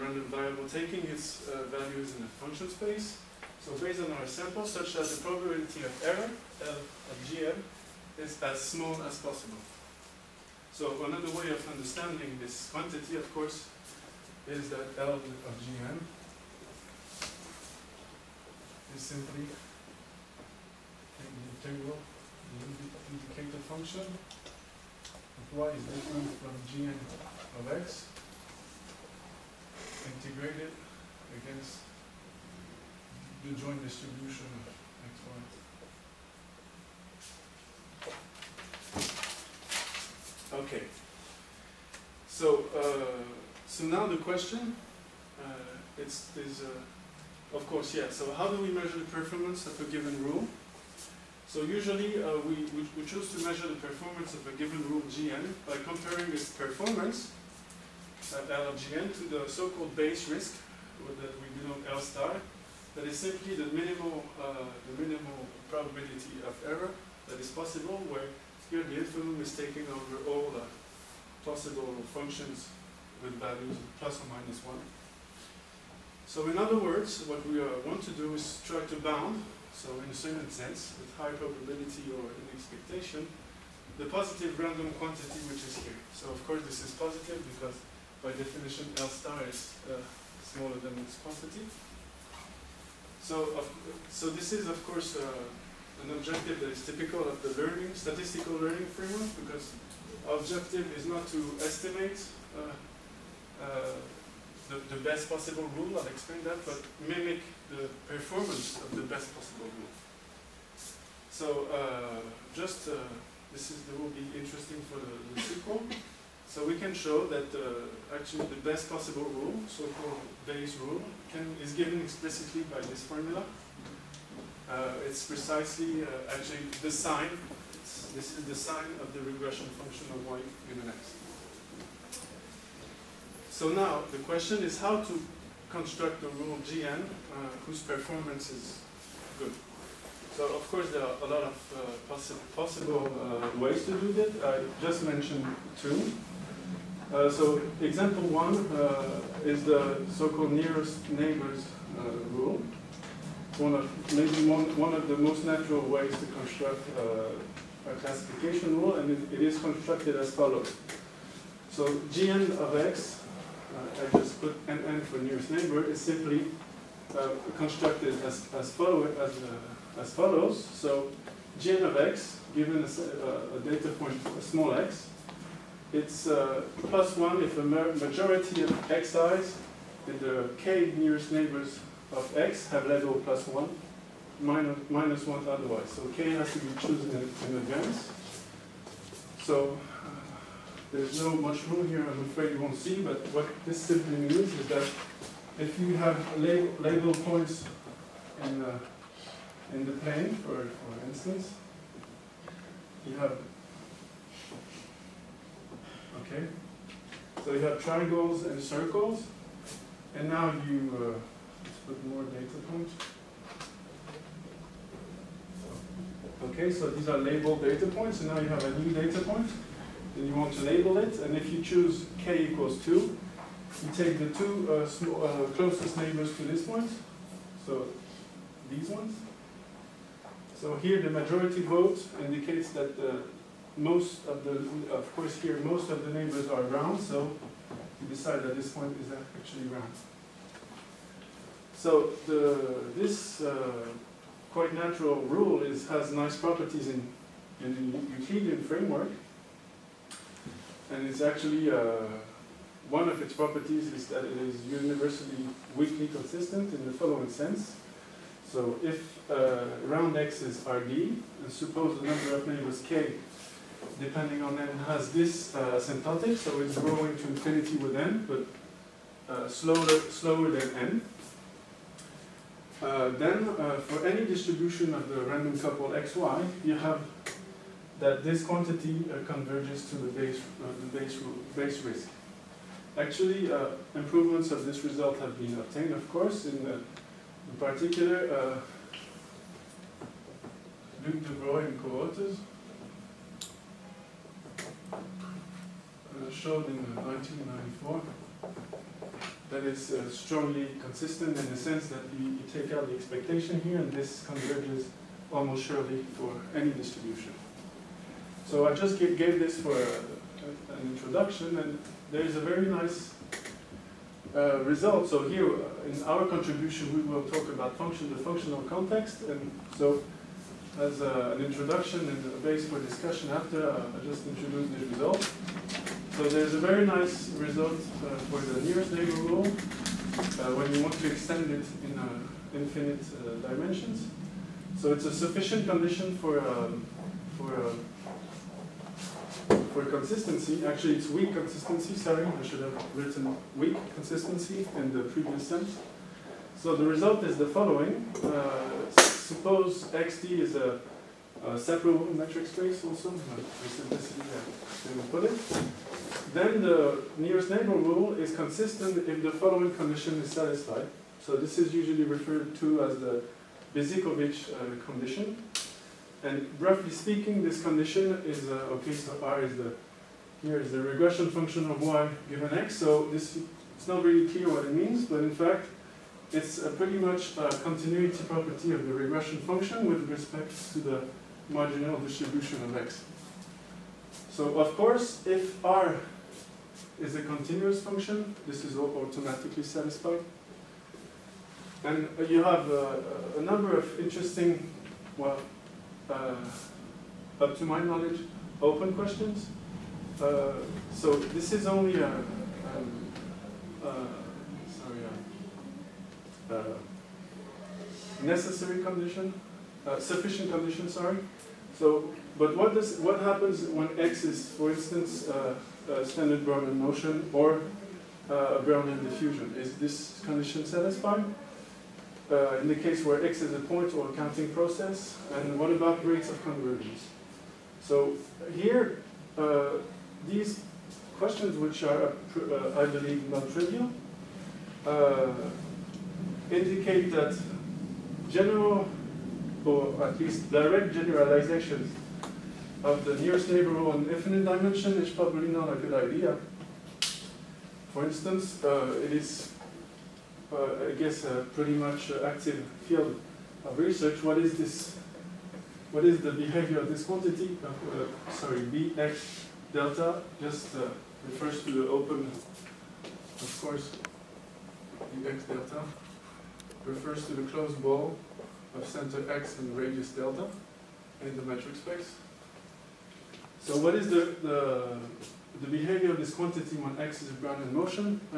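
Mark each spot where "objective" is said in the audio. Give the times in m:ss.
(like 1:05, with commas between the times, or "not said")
1:36, 1:40.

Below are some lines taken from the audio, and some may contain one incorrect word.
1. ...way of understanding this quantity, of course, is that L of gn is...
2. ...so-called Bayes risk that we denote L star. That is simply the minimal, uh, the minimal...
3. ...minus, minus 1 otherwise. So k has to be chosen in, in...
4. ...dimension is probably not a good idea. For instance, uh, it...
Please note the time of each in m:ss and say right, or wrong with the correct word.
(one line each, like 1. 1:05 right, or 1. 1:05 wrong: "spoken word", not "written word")
1. 0:11 right
2. 0:59 right
3. 3:04 right
4. 7:24 right.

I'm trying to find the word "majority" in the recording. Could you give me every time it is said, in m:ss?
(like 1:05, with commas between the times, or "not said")
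2:57, 3:51.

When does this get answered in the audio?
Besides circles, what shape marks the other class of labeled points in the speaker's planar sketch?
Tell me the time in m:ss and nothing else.
3:27.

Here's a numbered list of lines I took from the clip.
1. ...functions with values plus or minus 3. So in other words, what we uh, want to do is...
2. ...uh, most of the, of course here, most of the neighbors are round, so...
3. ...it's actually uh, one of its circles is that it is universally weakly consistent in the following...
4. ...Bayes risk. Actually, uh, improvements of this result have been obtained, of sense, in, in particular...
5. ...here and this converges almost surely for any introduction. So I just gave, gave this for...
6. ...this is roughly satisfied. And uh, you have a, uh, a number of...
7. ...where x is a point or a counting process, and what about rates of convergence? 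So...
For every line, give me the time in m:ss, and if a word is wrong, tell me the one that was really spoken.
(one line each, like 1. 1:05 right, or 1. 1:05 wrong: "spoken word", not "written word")
1. 1:12 wrong: "1", not "3"
2. 3:53 right
3. 4:11 wrong: "properties", not "circles"
4. 4:41 wrong: "course", not "sense"
5. 5:03 wrong: "distribution", not "introduction"
6. 6:28 wrong: "automatically", not "roughly"
7. 7:03 right.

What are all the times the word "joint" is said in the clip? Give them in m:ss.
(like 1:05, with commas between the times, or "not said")
0:33.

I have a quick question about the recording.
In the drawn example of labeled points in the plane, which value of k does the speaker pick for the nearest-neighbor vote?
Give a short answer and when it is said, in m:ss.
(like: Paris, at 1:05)
2, at 3:42.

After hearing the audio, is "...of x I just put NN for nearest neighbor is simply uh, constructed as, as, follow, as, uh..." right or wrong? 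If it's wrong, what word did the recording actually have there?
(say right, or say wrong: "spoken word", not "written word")
right.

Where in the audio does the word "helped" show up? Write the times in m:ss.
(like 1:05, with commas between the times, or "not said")
not said.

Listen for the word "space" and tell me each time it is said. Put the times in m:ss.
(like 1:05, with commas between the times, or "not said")
0:02, 5:52, 7:51.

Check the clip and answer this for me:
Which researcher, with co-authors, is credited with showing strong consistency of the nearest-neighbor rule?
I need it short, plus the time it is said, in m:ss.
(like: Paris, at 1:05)
Luc Devroye, at 4:51.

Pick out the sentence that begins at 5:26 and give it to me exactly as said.
So there's a very nice result uh, for the nearest neighbor rule uh, when you want to extend it in infinite dimensions.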